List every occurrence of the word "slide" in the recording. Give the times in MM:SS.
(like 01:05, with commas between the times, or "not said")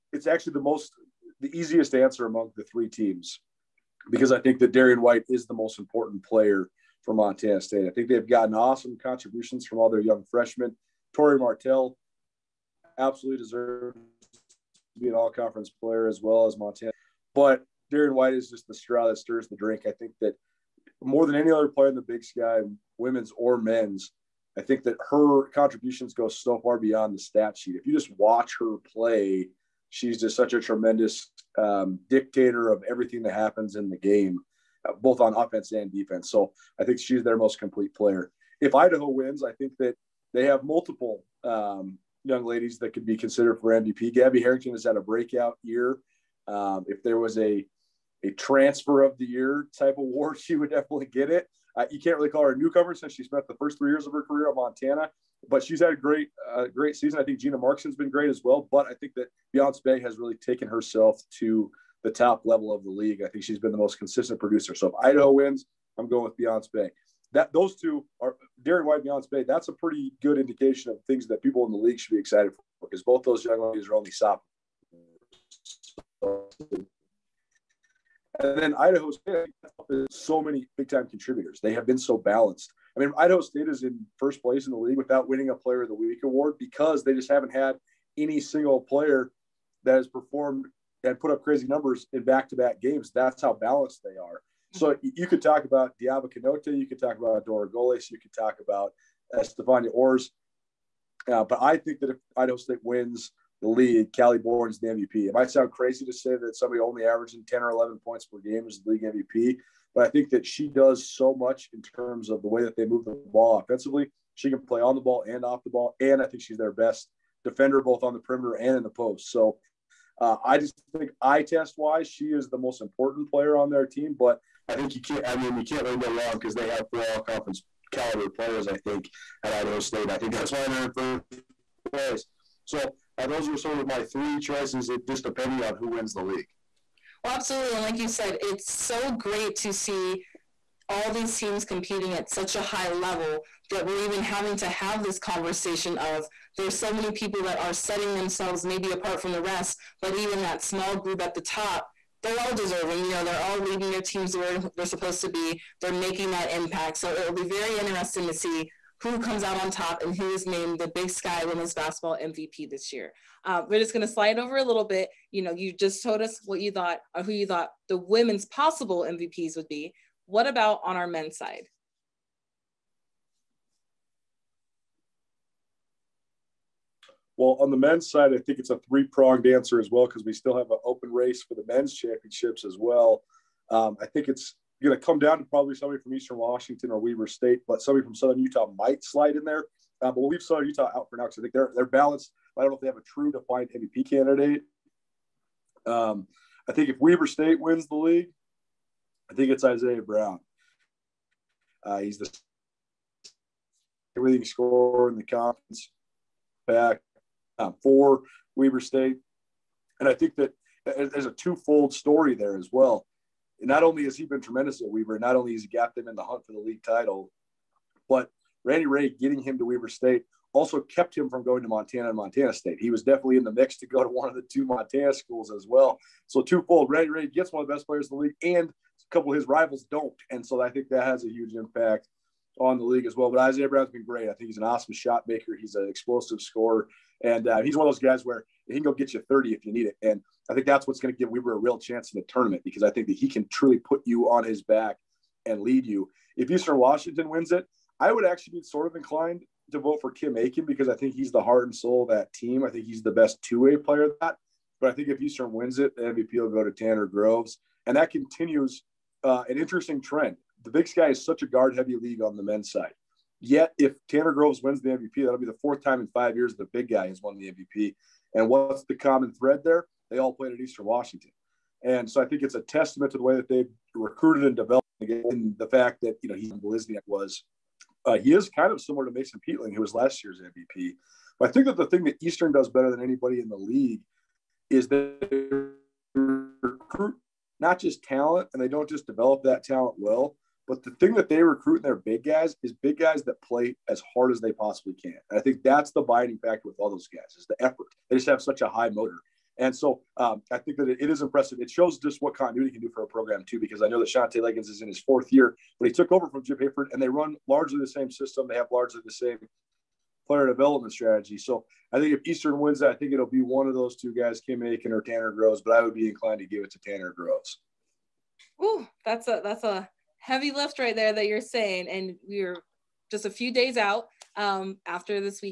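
02:44, 03:09.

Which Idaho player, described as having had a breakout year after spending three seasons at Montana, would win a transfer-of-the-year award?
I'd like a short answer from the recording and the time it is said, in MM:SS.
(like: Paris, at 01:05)
Gabby Harrington, at 00:44.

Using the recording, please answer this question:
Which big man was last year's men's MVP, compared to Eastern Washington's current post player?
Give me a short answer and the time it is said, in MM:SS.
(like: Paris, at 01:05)
Mason Peatling, at 04:39.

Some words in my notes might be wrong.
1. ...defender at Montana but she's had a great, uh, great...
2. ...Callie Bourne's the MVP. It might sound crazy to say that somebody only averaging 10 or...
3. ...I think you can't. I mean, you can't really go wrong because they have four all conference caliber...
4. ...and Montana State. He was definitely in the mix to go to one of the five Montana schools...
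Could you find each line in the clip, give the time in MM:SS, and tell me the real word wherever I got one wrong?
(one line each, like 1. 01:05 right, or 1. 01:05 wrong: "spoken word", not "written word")
1. 00:54 wrong: "career", not "defender"
2. 01:44 right
3. 02:04 right
4. 03:42 wrong: "two", not "five".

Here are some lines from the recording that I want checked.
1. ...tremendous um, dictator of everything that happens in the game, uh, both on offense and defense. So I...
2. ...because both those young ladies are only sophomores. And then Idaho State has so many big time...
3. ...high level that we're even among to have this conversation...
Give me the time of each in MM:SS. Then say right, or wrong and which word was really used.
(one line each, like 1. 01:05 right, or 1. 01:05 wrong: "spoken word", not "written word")
1. 00:30 right
2. 01:12 right
3. 02:22 wrong: "having", not "among".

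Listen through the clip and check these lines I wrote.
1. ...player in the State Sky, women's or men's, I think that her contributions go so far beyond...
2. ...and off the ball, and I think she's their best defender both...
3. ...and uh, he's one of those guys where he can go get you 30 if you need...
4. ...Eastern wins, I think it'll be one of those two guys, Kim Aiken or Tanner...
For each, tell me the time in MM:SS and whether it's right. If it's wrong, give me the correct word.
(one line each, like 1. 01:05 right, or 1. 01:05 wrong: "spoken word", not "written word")
1. 00:21 wrong: "Big", not "State"
2. 01:55 right
3. 03:57 right
4. 05:12 right.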